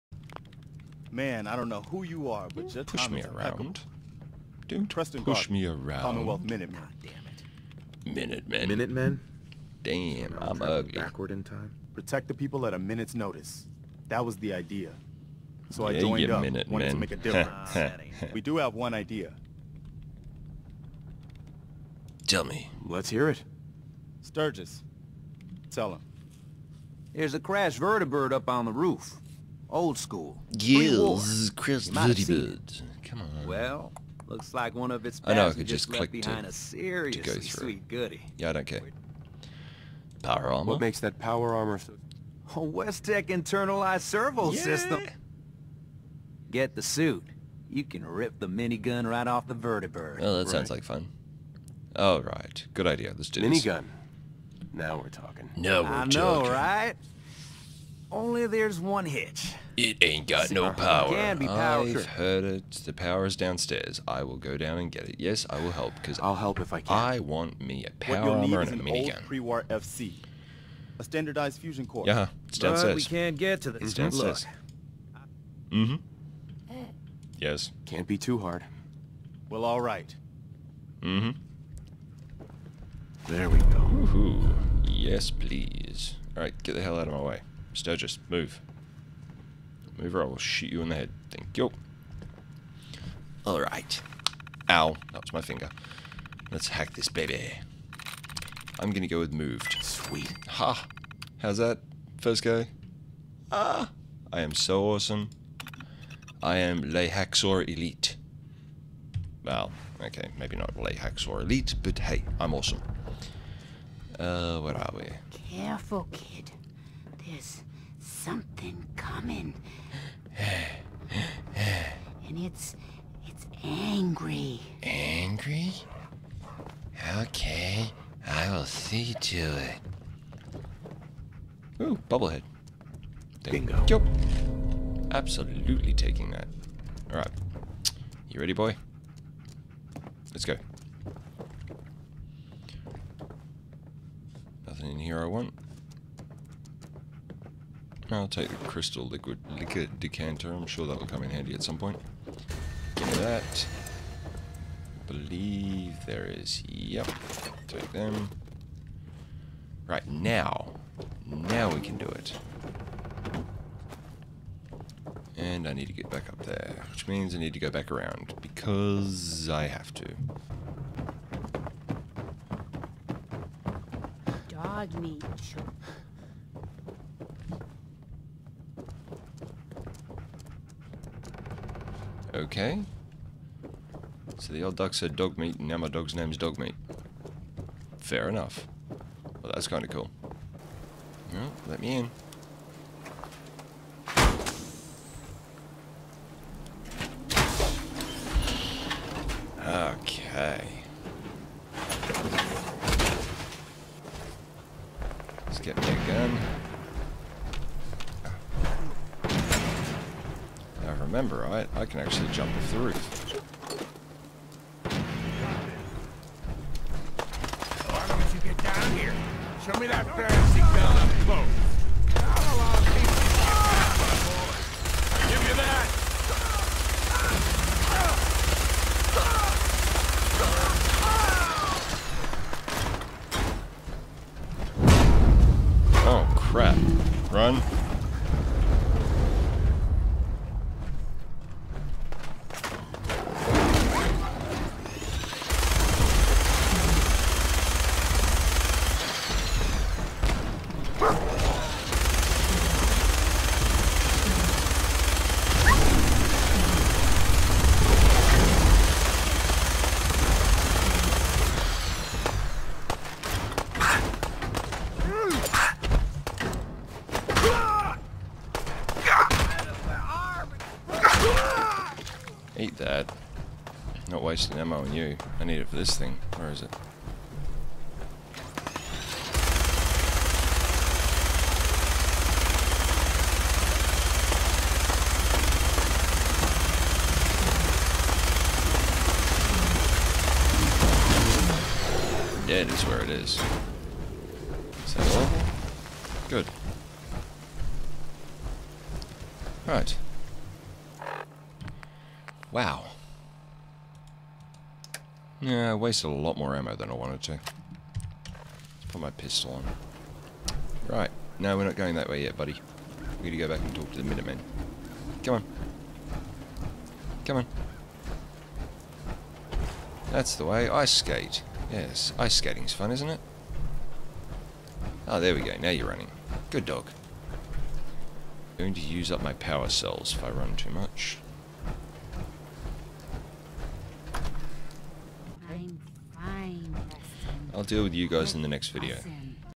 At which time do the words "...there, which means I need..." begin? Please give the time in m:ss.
2:46.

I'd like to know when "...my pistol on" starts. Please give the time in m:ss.
5:09.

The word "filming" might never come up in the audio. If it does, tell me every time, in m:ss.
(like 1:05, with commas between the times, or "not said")
not said.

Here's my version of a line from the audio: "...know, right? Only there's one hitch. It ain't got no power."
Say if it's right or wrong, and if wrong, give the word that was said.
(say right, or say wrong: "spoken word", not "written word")
right.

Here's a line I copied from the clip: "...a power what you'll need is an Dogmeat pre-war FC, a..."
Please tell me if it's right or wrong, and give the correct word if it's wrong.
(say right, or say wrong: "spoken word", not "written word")
wrong: "Old", not "Dogmeat".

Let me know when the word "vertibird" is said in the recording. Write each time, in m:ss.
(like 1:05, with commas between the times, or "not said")
0:27, 0:49.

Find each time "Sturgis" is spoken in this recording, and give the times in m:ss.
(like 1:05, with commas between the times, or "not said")
0:24, 1:27.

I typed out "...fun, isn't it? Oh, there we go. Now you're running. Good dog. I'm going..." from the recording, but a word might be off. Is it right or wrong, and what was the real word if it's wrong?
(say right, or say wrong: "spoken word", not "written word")
right.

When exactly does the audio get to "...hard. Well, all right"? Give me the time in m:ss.
1:18.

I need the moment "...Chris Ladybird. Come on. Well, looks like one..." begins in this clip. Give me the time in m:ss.
0:31.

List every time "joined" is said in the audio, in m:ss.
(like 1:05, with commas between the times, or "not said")
0:16.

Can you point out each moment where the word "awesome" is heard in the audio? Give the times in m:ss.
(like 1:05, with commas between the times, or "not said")
1:44, 1:52.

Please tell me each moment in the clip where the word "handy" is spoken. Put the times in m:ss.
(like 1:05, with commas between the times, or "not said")
2:31.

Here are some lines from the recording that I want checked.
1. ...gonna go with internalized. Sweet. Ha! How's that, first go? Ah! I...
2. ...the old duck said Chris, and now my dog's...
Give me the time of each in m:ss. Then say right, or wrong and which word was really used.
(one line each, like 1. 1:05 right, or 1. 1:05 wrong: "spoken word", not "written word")
1. 1:38 wrong: "moved", not "internalized"
2. 3:04 wrong: "Dogmeat", not "Chris".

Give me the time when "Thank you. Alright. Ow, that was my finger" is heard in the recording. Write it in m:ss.
1:31.